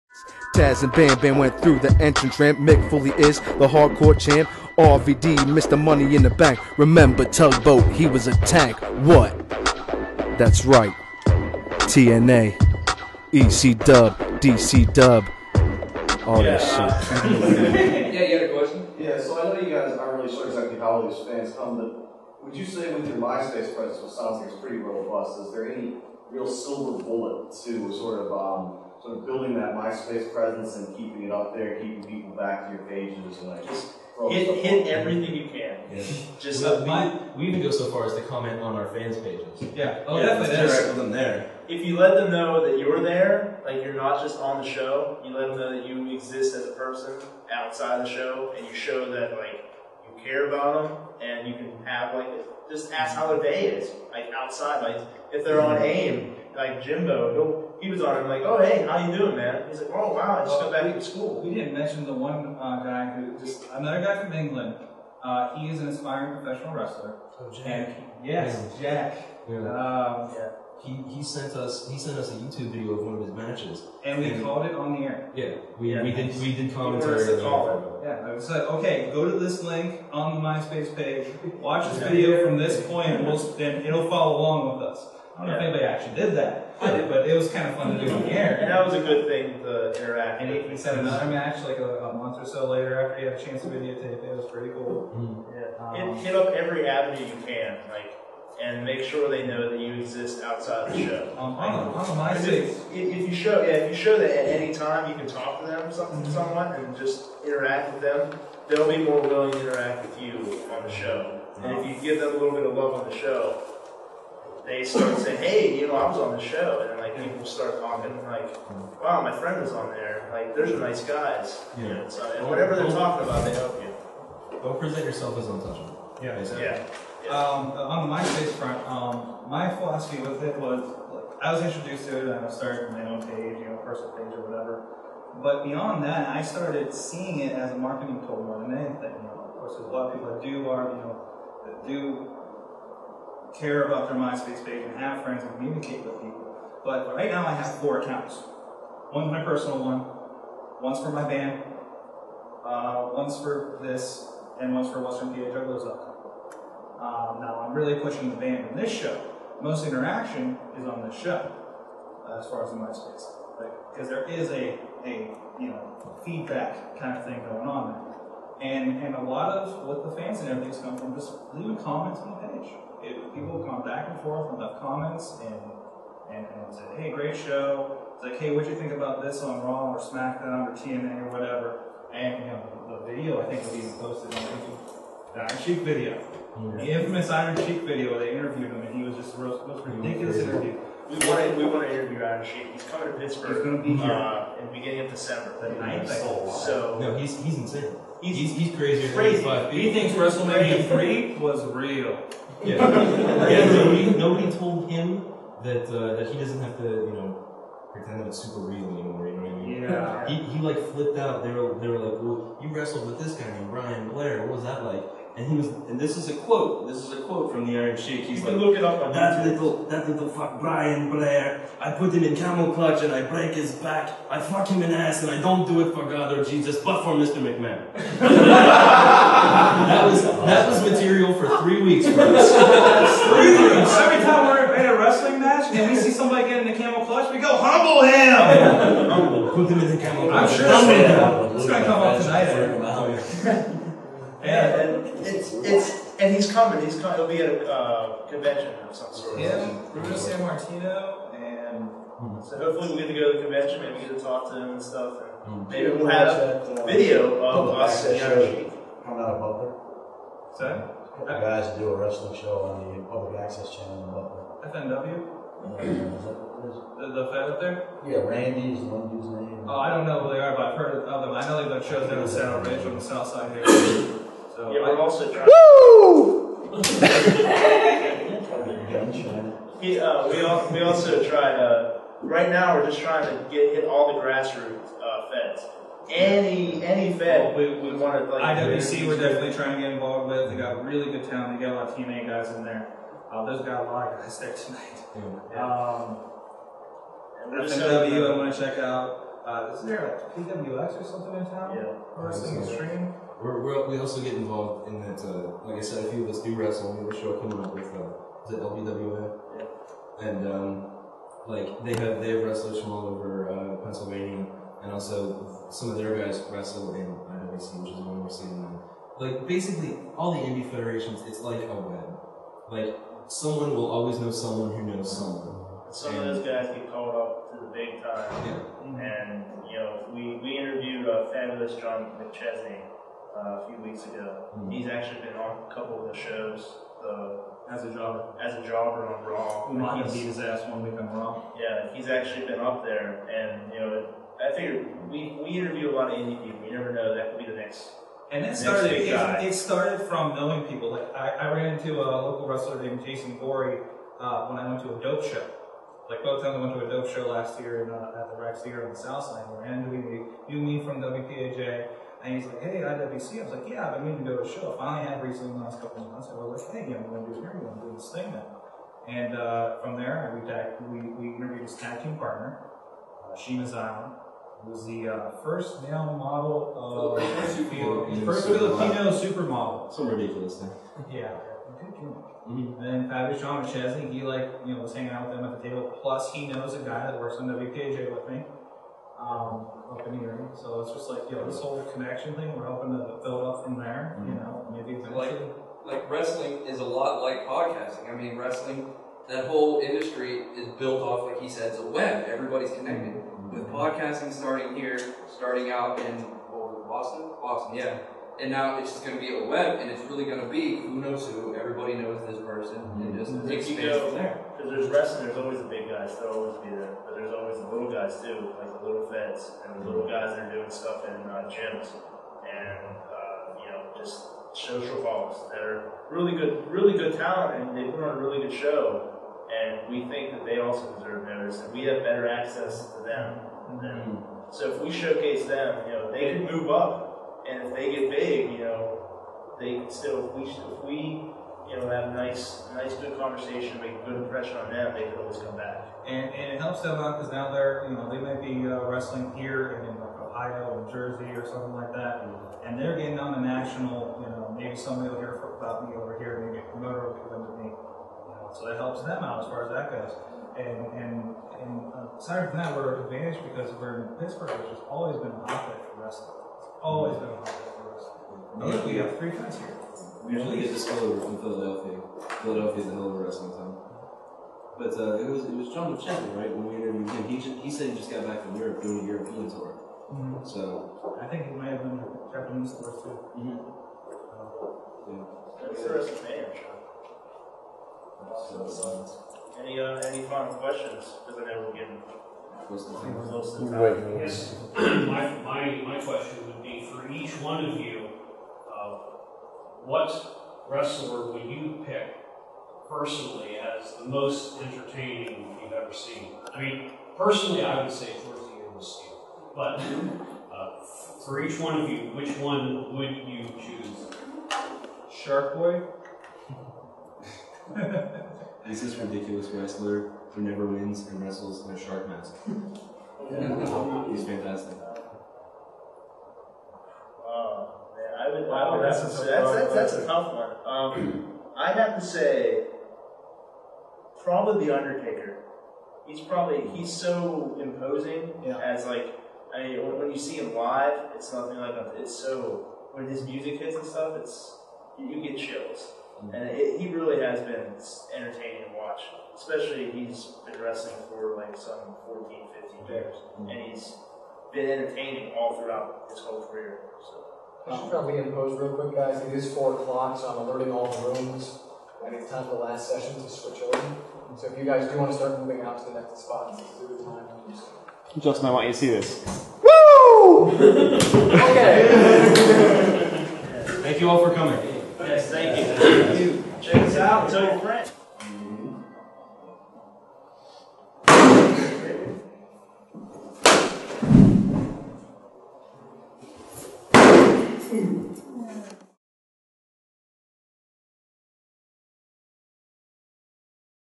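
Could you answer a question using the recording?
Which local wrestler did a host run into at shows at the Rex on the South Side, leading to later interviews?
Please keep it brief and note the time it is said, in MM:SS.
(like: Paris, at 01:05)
Jason Gory, at 05:53.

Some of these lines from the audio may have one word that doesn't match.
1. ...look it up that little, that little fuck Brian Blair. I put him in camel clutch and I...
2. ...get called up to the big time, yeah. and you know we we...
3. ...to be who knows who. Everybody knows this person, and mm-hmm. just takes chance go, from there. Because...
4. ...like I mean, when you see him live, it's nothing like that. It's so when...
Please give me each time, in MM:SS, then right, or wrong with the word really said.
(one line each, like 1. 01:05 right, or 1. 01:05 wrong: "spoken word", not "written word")
1. 03:38 right
2. 05:26 right
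3. 06:50 wrong: "space", not "chance"
4. 08:58 right.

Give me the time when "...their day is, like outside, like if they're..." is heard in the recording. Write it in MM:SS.
00:53.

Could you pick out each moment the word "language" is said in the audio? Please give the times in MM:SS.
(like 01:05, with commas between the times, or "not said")
not said.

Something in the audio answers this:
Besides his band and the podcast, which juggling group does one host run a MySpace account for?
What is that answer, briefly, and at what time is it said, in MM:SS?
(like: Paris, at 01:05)
Western PA Jugglers, at 02:35.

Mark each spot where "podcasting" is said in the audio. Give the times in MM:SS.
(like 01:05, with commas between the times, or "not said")
06:37, 06:43.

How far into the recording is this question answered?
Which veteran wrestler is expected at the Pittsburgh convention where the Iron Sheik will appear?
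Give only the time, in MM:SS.
04:09.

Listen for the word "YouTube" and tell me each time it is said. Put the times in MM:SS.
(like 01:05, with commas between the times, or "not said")
01:12, 03:04.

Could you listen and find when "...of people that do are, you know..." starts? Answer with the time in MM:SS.
02:20.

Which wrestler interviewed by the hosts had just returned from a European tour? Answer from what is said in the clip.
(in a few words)
John Pacheco.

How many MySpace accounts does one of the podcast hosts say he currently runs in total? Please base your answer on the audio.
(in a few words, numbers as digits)
4.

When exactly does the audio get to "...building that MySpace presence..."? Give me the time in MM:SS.
00:29.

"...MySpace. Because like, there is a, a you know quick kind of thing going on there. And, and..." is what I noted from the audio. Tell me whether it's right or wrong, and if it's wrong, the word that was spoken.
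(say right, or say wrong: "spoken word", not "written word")
wrong: "feedback", not "quick".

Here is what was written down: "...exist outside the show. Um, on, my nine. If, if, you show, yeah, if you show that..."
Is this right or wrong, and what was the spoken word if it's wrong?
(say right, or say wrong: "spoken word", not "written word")
wrong: "six", not "nine".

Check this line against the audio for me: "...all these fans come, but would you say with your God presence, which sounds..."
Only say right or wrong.
wrong.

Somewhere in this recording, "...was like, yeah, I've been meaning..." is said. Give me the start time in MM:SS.
06:03.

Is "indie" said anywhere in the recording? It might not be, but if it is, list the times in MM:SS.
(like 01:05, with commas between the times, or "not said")
05:20, 05:46.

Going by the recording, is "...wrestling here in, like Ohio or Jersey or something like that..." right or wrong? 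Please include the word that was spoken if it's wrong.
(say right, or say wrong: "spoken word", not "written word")
right.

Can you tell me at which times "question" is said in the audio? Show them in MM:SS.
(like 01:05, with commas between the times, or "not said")
00:18, 08:10, 08:16.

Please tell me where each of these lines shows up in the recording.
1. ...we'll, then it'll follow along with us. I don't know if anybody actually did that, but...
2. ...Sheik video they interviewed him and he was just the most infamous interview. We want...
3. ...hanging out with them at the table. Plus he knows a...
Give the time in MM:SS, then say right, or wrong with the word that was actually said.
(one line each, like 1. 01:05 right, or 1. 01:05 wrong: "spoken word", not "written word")
1. 01:23 right
2. 03:07 wrong: "ridiculous", not "infamous"
3. 06:24 right.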